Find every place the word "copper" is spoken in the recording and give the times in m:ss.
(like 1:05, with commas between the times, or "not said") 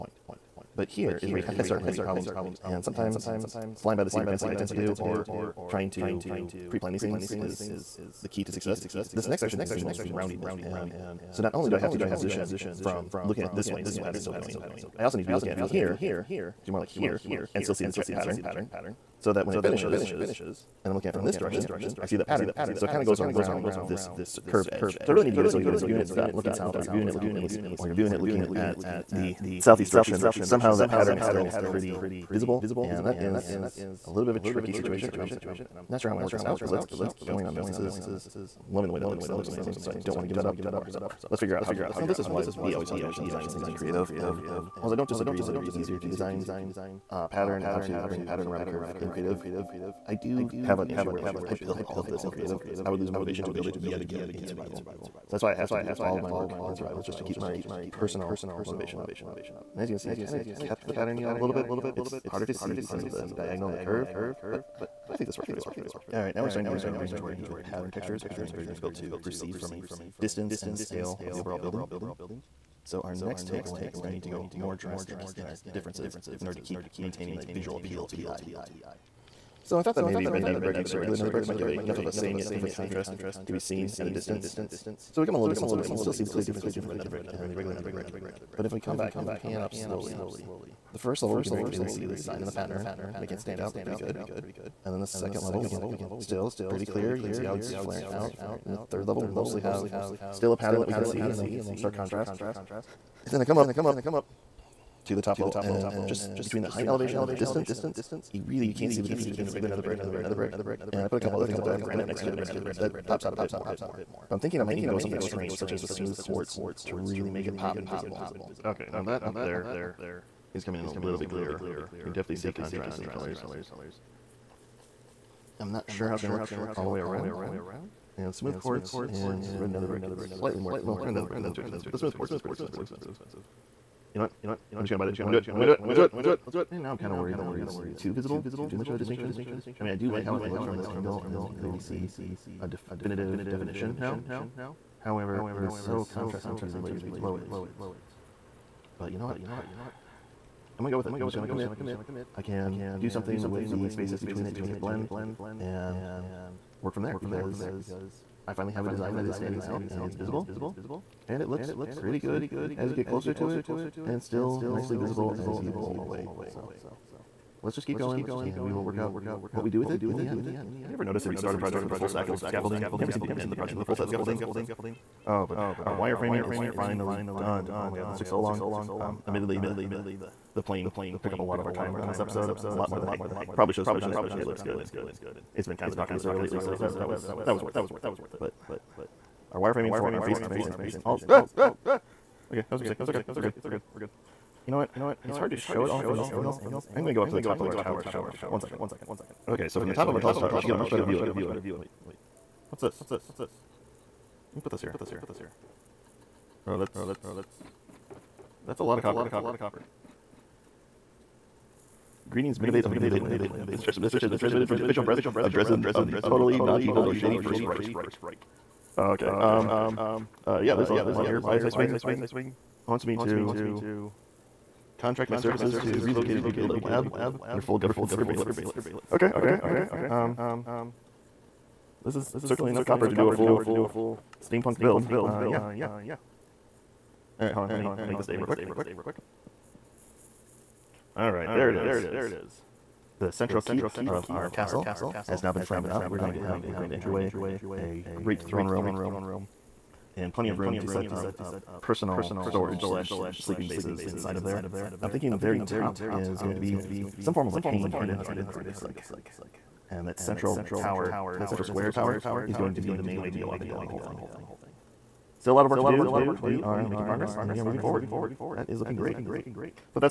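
3:29, 3:52.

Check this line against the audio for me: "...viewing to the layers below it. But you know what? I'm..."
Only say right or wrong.
wrong.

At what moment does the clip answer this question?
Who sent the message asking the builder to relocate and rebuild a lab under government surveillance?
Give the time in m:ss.
3:41.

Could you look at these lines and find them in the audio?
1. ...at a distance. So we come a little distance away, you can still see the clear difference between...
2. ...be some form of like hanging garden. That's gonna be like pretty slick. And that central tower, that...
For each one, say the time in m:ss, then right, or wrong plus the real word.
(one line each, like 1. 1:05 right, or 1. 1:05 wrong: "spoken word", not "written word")
1. 1:24 right
2. 4:16 right.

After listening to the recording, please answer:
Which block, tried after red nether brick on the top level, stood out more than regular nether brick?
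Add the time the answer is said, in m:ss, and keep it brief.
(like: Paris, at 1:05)
Granite, at 1:51.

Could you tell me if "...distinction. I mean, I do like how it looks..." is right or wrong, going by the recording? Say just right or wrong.
right.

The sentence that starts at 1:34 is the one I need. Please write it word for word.
And then the second level we can still pretty clear.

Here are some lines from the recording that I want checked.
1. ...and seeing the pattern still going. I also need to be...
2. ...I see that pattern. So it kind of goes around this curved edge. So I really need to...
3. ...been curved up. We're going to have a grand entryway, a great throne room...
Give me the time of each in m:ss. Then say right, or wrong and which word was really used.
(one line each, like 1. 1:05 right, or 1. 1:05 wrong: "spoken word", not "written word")
1. 0:13 right
2. 0:22 right
3. 4:05 wrong: "framed", not "curved".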